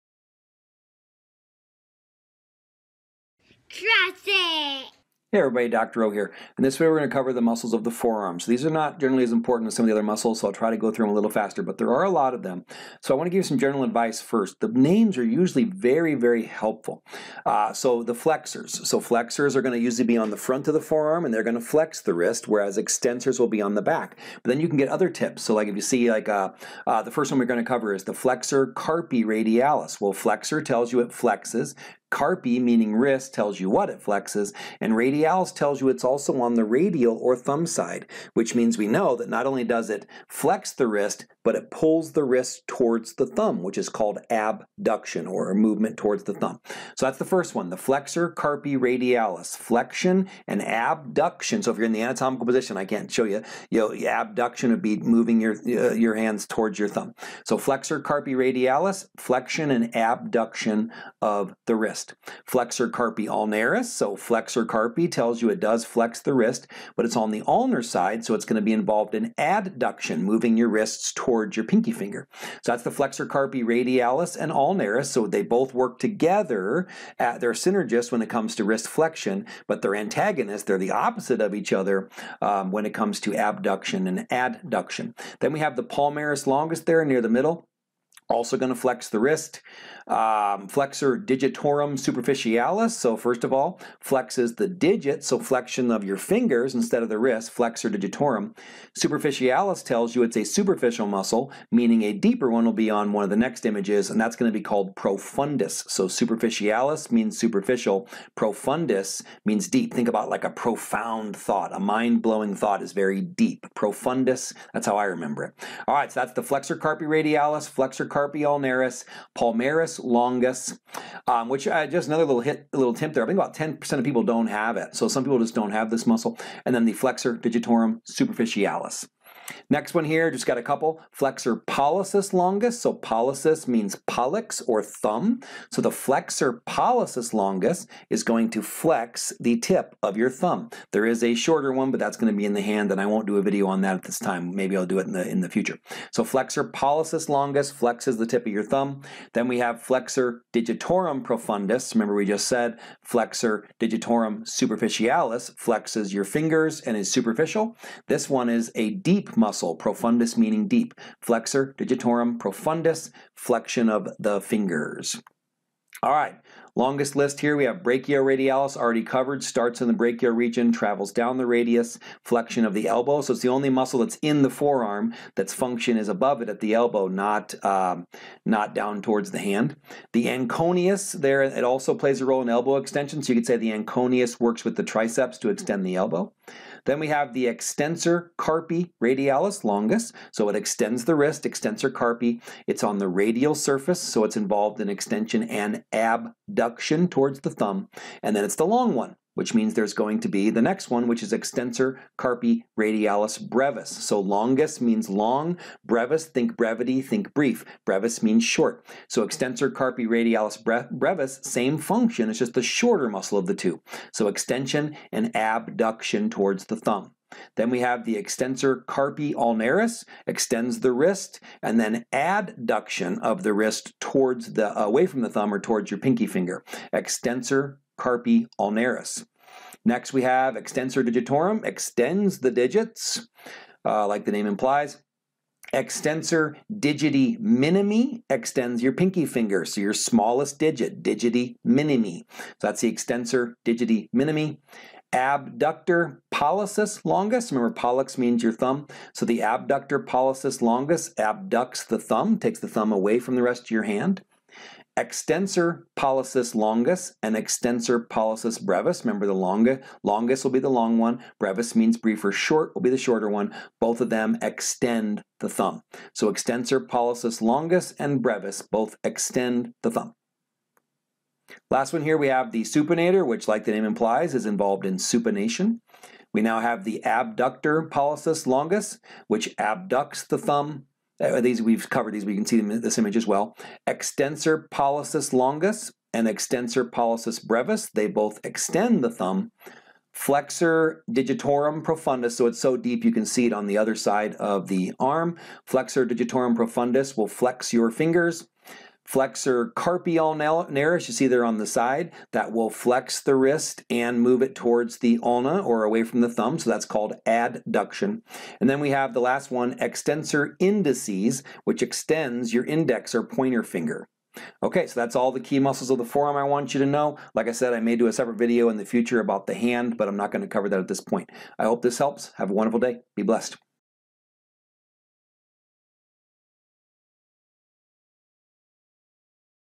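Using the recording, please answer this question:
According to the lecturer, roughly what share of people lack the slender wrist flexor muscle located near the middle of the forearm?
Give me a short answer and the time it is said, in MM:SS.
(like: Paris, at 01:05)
10%, at 02:03.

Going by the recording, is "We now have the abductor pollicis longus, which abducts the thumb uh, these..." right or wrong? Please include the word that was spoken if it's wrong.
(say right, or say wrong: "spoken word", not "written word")
right.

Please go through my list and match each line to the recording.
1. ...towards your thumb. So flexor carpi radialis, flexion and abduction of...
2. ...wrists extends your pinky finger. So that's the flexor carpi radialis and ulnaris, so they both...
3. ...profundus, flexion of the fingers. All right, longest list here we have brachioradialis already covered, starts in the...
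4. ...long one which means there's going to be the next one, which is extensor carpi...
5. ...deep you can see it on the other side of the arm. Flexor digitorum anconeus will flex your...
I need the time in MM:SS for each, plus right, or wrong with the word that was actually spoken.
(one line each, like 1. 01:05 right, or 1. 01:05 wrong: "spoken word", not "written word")
1. 00:56 right
2. 01:10 wrong: "towards", not "extends"
3. 02:42 right
4. 03:18 right
5. 04:52 wrong: "profundus", not "anconeus".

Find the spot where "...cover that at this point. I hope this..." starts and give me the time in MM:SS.
05:20.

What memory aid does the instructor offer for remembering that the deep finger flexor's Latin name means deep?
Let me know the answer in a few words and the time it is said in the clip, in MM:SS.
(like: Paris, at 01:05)
a profound thought, at 01:50.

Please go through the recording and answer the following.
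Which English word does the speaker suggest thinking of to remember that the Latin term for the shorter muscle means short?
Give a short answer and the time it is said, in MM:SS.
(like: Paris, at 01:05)
brevity, at 03:26.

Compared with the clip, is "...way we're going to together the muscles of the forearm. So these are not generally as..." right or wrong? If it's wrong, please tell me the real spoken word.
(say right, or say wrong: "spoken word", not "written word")
wrong: "cover", not "together".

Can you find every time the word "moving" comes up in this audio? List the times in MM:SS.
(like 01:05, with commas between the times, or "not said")
00:54, 01:10.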